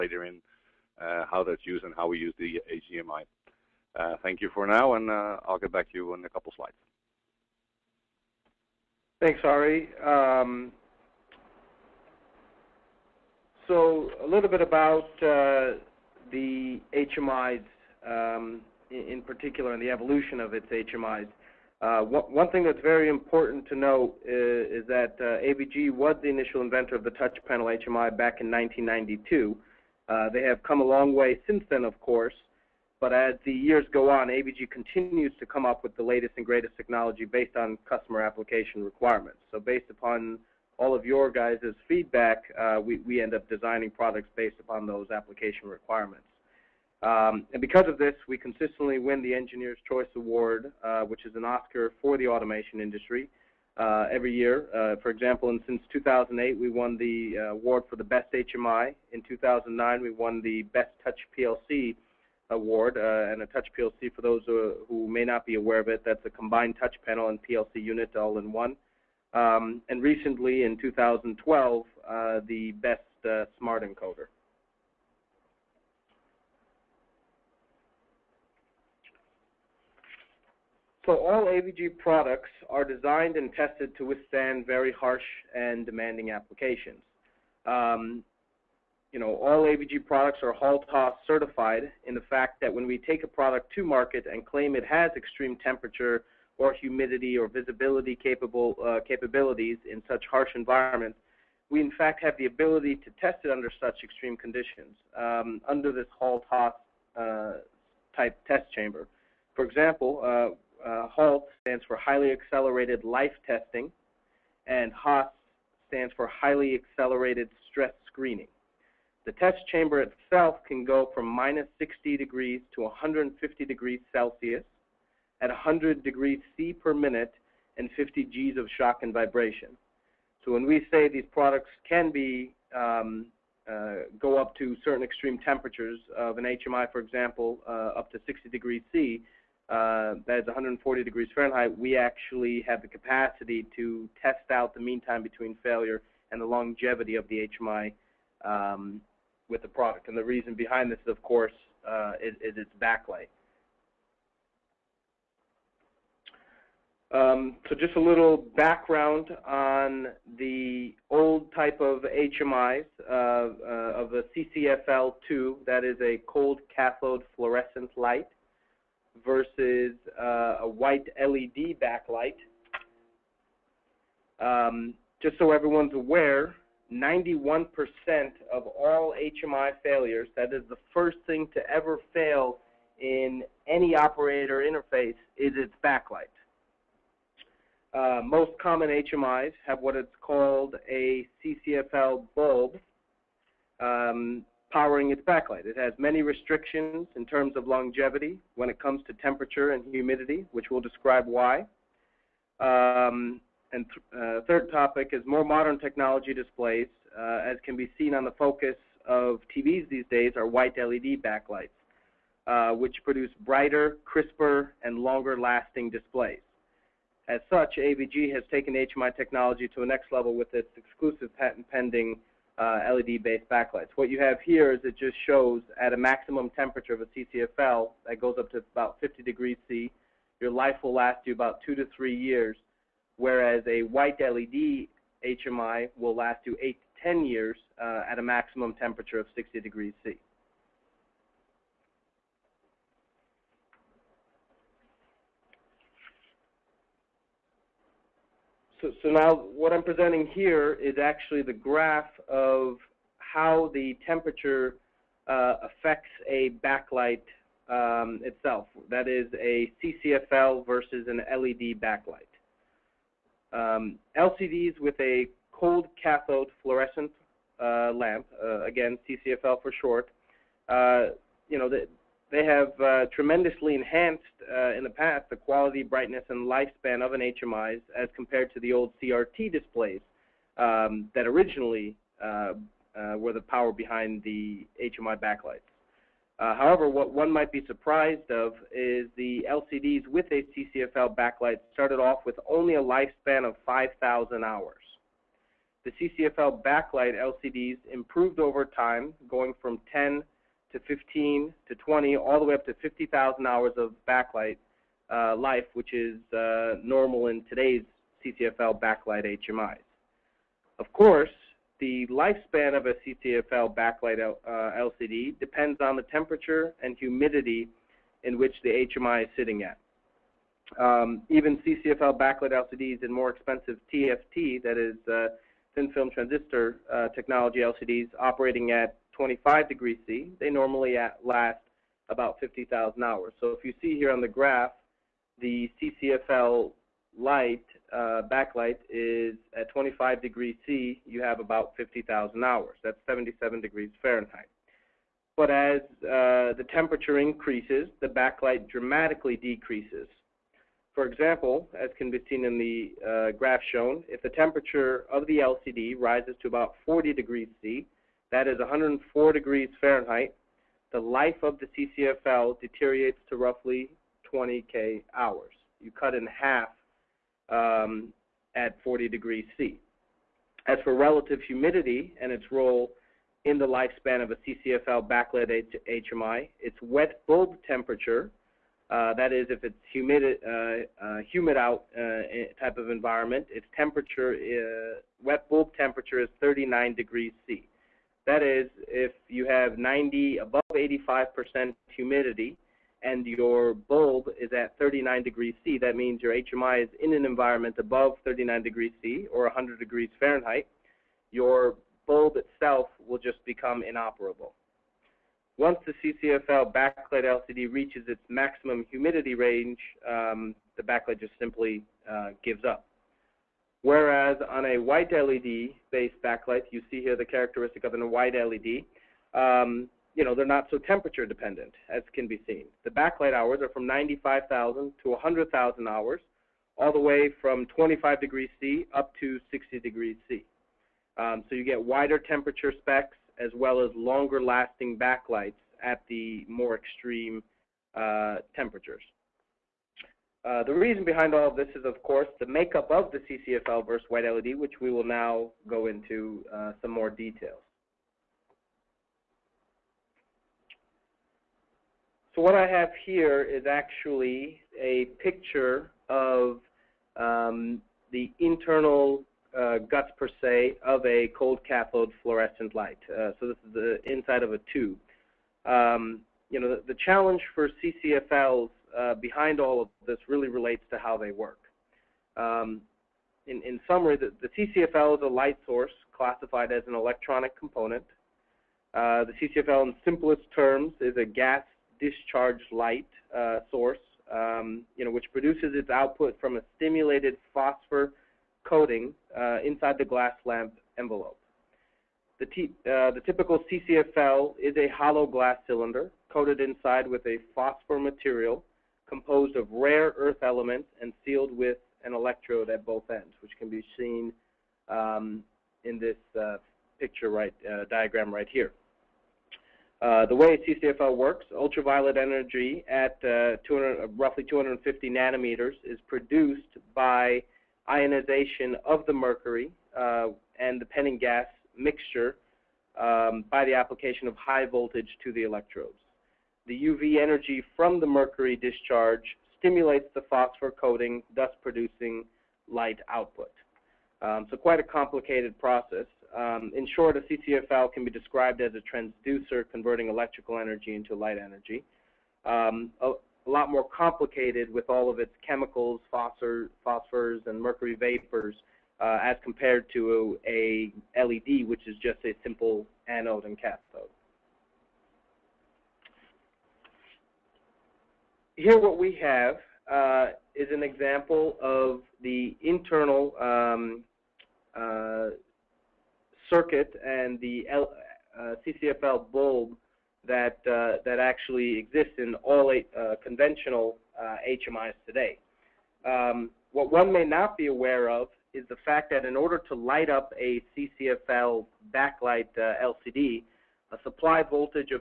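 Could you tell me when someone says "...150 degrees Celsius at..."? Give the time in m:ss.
2:02.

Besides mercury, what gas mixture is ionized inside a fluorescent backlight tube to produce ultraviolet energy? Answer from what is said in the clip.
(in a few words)
Penning gas mixture.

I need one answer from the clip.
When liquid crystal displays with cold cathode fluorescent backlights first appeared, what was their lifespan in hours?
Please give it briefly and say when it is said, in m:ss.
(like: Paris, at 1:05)
5,000 hours, at 4:53.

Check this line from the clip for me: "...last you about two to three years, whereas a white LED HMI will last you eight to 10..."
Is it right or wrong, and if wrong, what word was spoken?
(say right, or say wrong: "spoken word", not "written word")
right.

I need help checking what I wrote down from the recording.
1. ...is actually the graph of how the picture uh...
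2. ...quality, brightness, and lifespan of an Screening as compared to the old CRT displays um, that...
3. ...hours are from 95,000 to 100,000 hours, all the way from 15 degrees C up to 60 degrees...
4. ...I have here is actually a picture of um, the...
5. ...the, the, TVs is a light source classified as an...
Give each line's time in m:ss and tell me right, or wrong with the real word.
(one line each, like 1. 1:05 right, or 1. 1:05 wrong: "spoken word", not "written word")
1. 4:10 wrong: "temperature", not "picture"
2. 4:35 wrong: "HMIs", not "Screening"
3. 7:03 wrong: "25", not "15"
4. 7:32 right
5. 7:54 wrong: "CCFL", not "TVs".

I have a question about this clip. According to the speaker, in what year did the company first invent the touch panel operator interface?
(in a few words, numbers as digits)
1992.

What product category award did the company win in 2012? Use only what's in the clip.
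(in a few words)
Best Smart Encoder.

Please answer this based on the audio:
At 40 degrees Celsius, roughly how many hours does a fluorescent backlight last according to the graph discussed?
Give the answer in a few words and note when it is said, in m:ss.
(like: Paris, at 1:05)
20,000 hours, at 6:04.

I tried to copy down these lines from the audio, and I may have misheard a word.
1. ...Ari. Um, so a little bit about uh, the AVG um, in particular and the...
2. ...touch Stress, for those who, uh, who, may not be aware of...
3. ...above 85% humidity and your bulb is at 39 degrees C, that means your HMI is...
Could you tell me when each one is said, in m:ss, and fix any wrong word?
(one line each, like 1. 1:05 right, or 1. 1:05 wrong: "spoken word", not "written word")
1. 0:09 wrong: "HMIs", not "AVG"
2. 1:03 wrong: "PLC", not "Stress"
3. 6:30 right.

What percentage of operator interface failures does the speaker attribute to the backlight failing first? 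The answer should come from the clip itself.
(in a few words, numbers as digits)
91%.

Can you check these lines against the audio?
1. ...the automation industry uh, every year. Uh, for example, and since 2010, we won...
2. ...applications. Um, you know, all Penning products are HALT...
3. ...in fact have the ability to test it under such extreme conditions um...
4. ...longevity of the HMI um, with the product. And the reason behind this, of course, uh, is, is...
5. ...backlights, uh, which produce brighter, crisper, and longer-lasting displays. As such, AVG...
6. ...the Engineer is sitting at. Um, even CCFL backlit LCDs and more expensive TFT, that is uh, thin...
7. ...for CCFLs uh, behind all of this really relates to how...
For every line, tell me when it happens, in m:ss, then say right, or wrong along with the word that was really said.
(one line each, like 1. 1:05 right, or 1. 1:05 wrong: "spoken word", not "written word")
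1. 0:52 wrong: "2008", not "2010"
2. 1:26 wrong: "AVG", not "Penning"
3. 1:41 right
4. 2:26 right
5. 3:31 right
6. 5:18 wrong: "HMI", not "Engineer"
7. 7:47 right.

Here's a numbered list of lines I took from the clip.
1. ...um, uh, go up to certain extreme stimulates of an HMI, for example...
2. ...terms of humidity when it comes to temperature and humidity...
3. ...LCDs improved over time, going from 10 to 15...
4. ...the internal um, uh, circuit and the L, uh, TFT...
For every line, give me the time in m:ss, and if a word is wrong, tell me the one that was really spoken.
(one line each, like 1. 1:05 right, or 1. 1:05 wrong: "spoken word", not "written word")
1. 2:12 wrong: "temperatures", not "stimulates"
2. 3:17 wrong: "longevity", not "humidity"
3. 4:57 right
4. 9:22 wrong: "CCFL", not "TFT".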